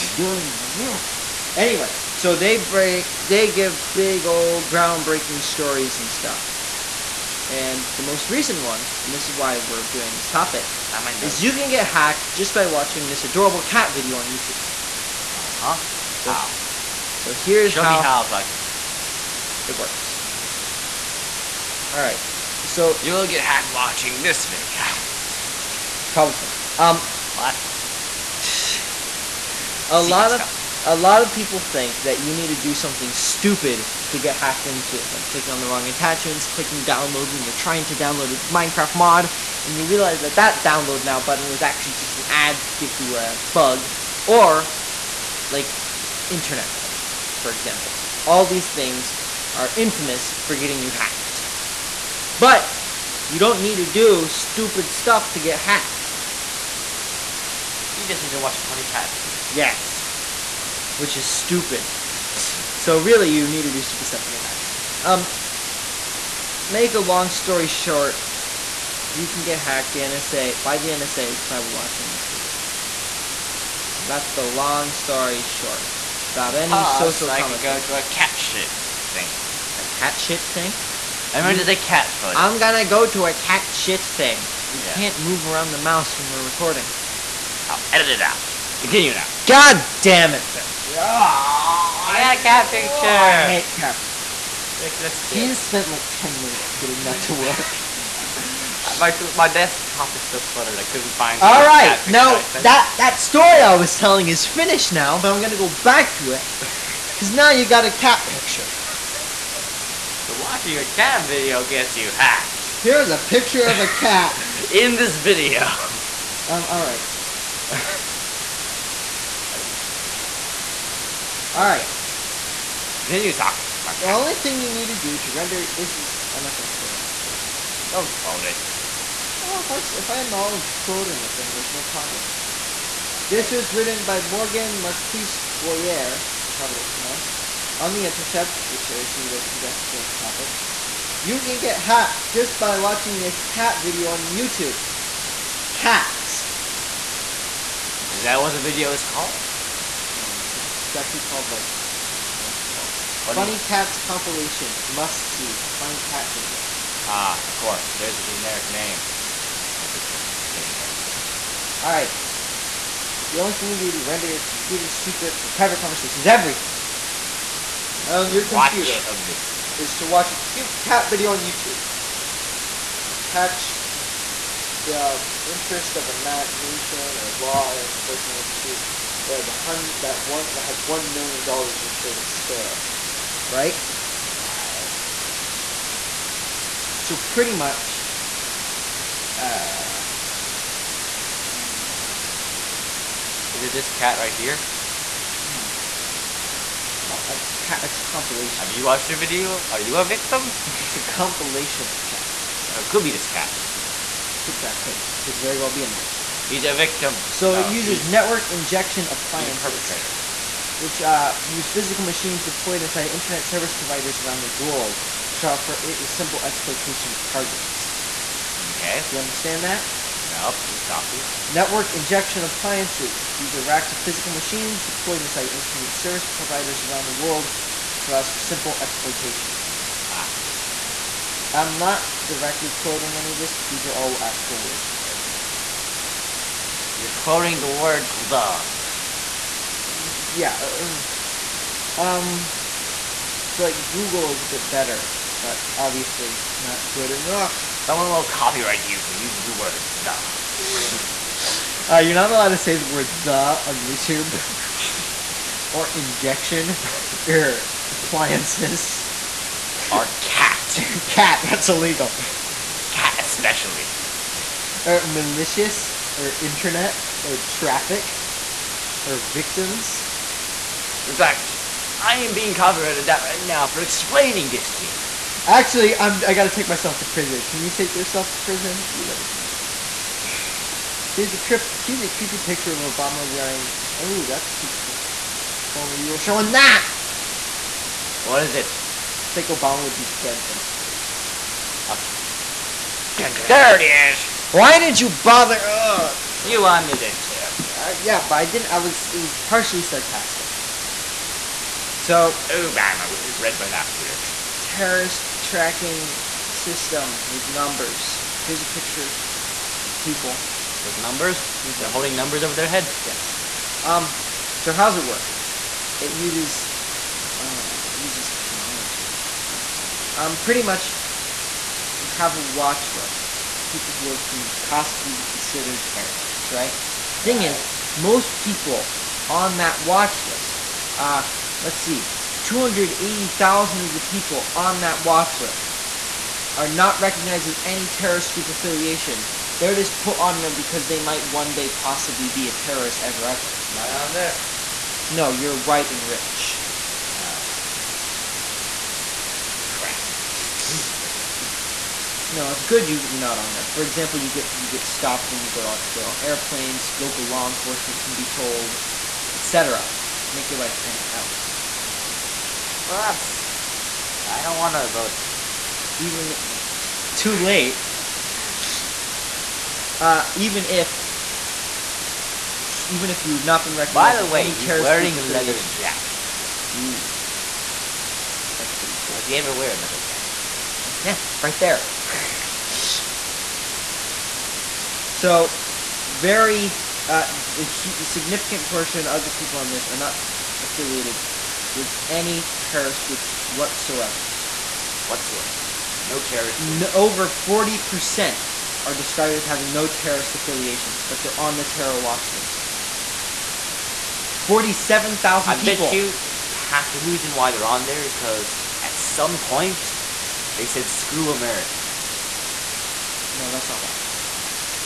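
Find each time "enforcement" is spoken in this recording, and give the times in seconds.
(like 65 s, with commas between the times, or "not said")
177 s, 357 s.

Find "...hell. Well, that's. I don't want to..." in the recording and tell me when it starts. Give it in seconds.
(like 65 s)
361 s.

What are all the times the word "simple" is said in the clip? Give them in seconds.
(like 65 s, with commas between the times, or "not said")
216 s, 228 s.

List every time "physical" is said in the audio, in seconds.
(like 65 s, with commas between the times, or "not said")
211 s, 223 s.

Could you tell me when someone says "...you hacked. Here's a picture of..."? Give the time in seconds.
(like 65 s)
111 s.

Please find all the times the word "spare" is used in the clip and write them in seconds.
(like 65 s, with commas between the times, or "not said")
182 s.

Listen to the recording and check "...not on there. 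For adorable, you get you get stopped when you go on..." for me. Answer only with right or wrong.
wrong.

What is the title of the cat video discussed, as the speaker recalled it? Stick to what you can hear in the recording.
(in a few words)
Funny Cats compilation.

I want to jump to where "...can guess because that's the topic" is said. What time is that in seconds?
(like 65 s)
139 s.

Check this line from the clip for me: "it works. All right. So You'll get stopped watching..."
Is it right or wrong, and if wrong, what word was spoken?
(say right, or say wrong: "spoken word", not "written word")
wrong: "hacked", not "stopped".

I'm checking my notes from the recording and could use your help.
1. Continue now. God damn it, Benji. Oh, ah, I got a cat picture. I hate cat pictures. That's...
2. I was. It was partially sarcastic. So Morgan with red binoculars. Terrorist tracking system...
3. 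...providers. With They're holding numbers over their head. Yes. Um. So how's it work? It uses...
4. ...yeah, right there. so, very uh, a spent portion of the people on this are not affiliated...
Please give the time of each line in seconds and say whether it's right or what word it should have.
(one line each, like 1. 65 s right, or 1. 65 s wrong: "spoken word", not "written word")
1. 88 s right
2. 298 s wrong: "Obama", not "Morgan"
3. 310 s wrong: "numbers", not "providers"
4. 381 s wrong: "significant", not "spent".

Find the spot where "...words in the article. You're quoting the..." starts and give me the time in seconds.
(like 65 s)
234 s.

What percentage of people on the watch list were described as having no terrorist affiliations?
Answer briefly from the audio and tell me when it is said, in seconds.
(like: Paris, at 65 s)
over 40%, at 396 s.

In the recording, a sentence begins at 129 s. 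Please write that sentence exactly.
Oh, if I if I acknowledge quoting it, then there's no problem.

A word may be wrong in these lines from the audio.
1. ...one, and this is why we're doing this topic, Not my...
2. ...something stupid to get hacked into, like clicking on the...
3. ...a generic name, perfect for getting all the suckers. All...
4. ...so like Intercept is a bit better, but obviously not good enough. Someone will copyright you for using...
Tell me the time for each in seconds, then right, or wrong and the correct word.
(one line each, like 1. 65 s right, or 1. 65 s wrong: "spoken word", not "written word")
1. 8 s right
2. 32 s right
3. 158 s right
4. 243 s wrong: "Google", not "Intercept".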